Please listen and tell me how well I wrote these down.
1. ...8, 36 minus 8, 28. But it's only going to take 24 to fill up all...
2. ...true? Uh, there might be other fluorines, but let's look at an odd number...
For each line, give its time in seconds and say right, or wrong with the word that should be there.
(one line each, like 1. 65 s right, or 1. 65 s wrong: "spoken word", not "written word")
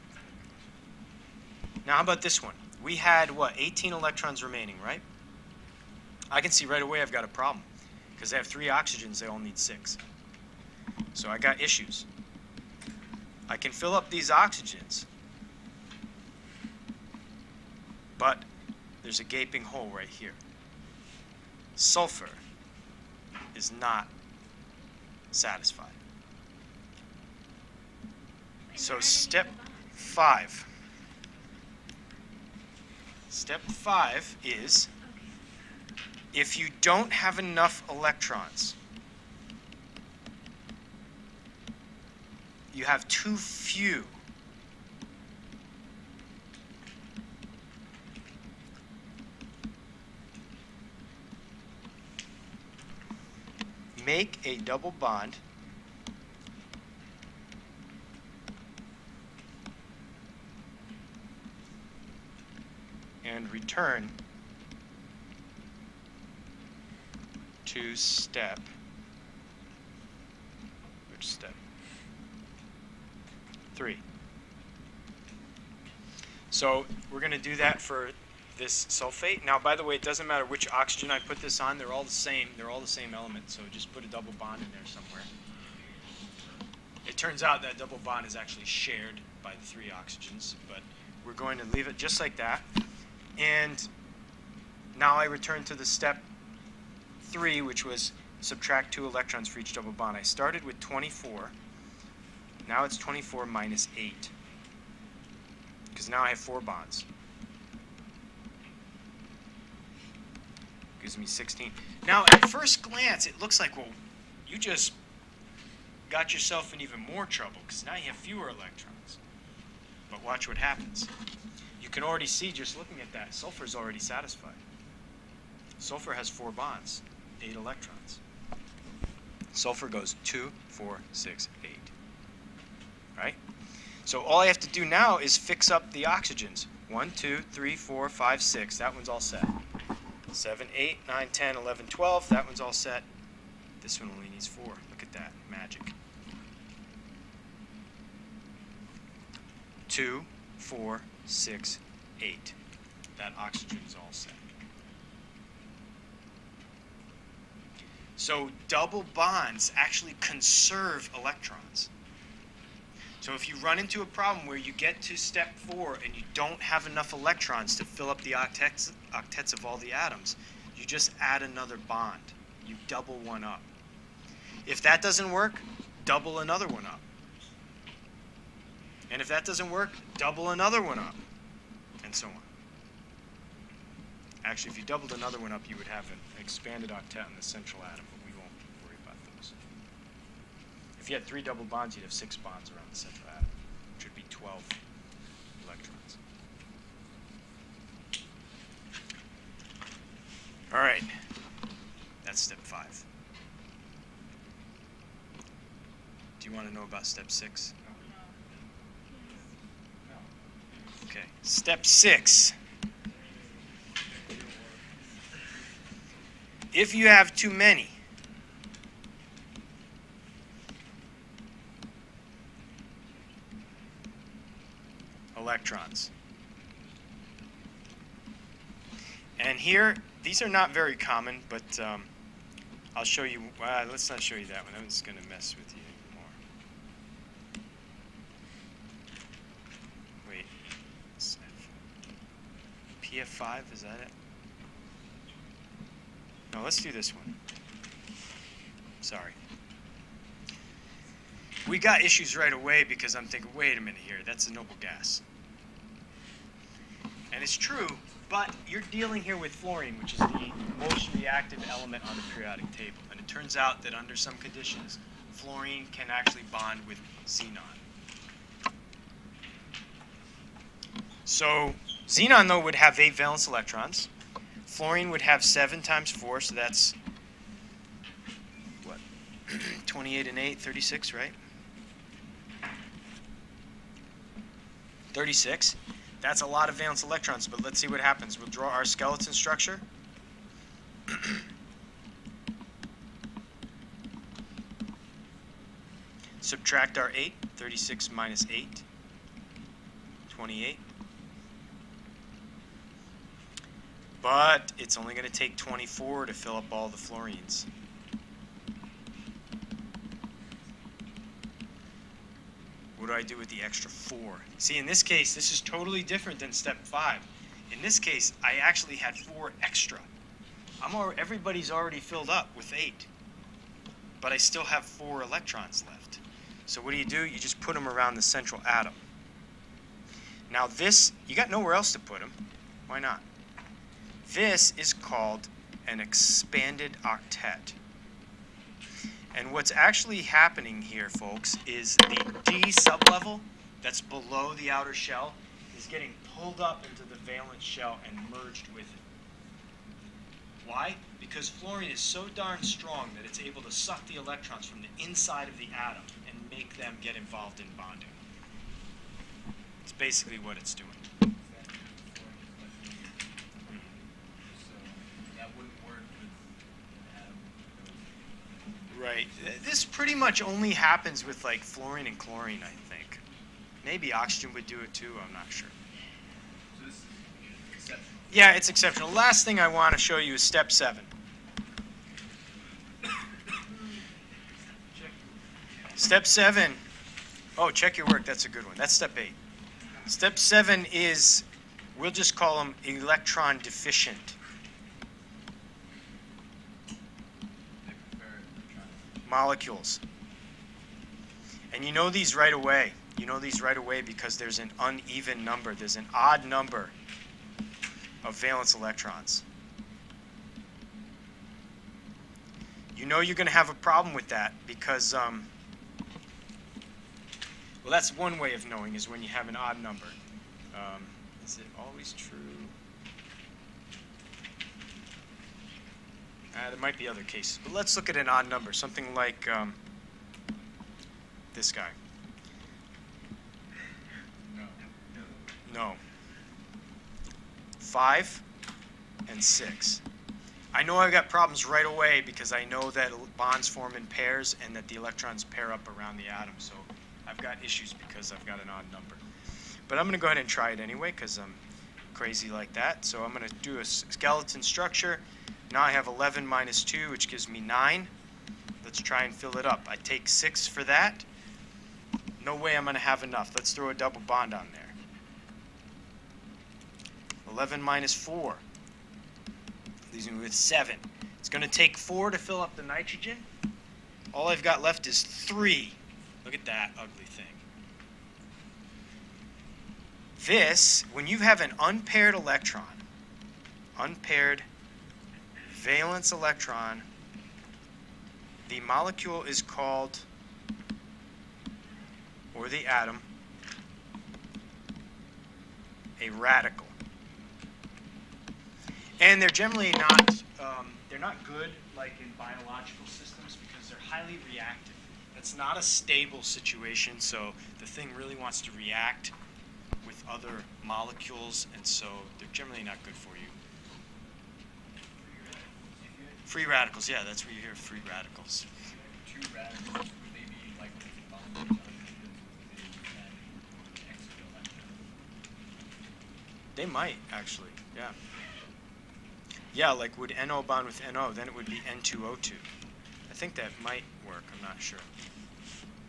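1. 297 s right
2. 422 s wrong: "cases", not "fluorines".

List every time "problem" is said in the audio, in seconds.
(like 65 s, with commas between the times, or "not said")
7 s, 164 s, 413 s, 441 s.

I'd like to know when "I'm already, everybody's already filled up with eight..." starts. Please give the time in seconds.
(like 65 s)
320 s.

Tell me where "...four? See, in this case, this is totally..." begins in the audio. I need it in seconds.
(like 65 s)
313 s.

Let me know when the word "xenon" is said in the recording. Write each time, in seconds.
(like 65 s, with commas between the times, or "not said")
267 s, 272 s.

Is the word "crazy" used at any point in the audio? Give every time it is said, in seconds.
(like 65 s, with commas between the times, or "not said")
452 s.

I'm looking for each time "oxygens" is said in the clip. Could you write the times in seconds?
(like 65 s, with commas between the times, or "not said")
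8 s, 14 s, 80 s, 89 s, 136 s, 153 s, 374 s.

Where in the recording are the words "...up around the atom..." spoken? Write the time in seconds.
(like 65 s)
445 s.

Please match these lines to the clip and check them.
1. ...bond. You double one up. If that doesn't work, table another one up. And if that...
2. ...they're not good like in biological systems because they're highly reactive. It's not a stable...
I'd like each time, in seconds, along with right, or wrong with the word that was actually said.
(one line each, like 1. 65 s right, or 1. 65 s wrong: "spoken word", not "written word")
1. 171 s wrong: "double", not "table"
2. 501 s right.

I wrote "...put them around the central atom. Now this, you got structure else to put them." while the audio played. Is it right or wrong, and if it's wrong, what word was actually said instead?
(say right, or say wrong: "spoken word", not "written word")
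wrong: "nowhere", not "structure".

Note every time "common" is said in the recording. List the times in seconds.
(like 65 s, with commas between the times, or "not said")
230 s.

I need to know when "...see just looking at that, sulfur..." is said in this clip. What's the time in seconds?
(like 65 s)
122 s.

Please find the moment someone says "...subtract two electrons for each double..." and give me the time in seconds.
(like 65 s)
98 s.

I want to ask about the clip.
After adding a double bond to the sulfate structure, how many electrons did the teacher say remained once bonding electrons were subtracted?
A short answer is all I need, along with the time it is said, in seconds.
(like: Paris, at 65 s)
16, at 111 s.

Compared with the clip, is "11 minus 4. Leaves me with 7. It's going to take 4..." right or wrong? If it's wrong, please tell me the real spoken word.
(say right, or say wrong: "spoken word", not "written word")
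right.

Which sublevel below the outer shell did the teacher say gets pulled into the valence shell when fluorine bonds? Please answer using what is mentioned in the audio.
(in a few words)
D sublevel.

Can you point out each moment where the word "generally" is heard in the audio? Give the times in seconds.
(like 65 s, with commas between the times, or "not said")
499 s, 512 s.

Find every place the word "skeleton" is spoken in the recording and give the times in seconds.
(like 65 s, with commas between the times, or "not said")
288 s, 453 s.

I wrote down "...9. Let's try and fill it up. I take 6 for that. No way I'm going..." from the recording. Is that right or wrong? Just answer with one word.
right.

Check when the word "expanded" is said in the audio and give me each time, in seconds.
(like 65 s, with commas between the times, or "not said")
186 s, 335 s.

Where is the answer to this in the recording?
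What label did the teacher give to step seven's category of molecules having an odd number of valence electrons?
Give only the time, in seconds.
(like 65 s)
392 s.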